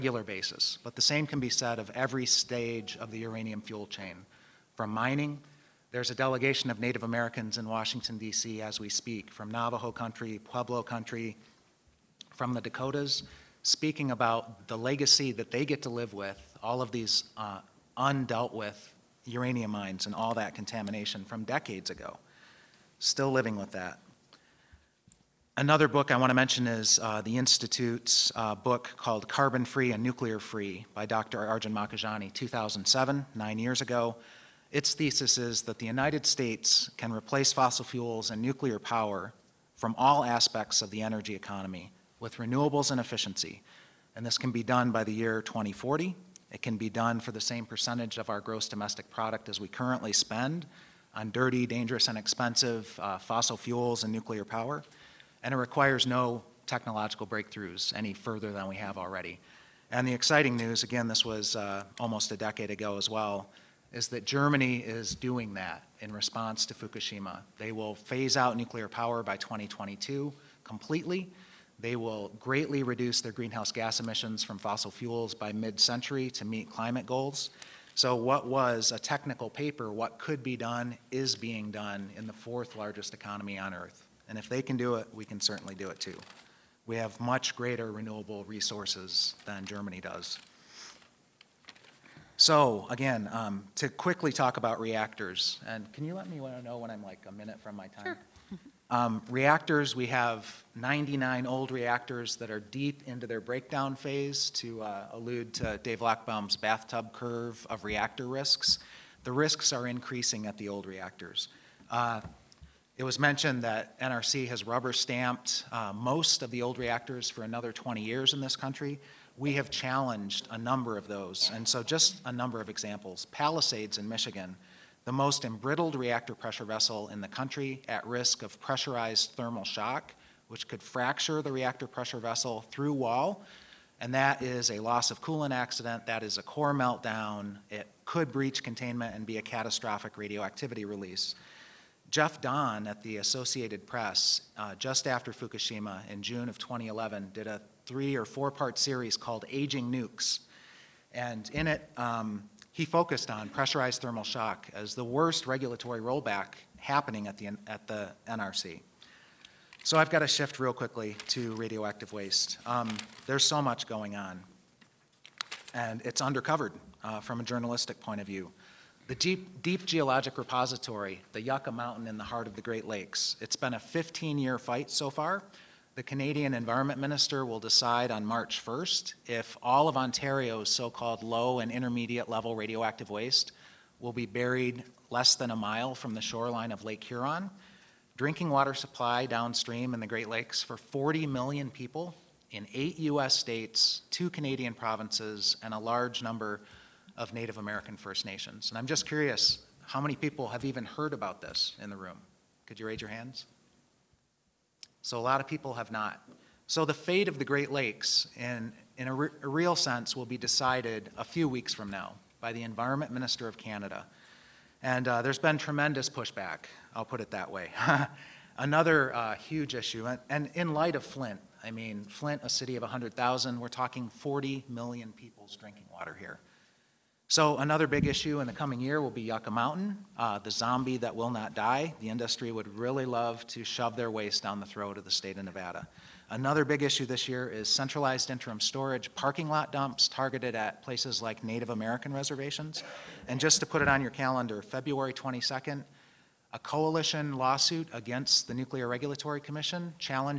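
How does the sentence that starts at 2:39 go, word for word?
So I've got to shift real quickly to radioactive waste.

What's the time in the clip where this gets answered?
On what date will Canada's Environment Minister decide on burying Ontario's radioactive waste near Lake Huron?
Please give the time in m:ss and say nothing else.
2:58.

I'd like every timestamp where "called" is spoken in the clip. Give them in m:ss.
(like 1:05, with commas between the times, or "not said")
0:28, 2:29, 3:00.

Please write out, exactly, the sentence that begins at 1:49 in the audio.
The risks are increasing at the old reactors.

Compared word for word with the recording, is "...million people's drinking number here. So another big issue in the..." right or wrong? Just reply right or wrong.
wrong.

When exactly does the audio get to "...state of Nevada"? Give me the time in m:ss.
3:55.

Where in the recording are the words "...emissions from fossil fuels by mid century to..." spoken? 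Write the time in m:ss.
1:14.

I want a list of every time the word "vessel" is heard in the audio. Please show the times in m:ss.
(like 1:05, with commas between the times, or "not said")
2:06, 2:12.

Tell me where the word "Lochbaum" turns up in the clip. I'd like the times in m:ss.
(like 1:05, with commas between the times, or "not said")
1:46.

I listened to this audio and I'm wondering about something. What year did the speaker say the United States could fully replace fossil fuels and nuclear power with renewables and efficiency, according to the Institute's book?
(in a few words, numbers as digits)
2040.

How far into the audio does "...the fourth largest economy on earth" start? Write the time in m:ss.
1:22.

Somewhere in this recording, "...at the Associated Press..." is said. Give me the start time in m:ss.
2:22.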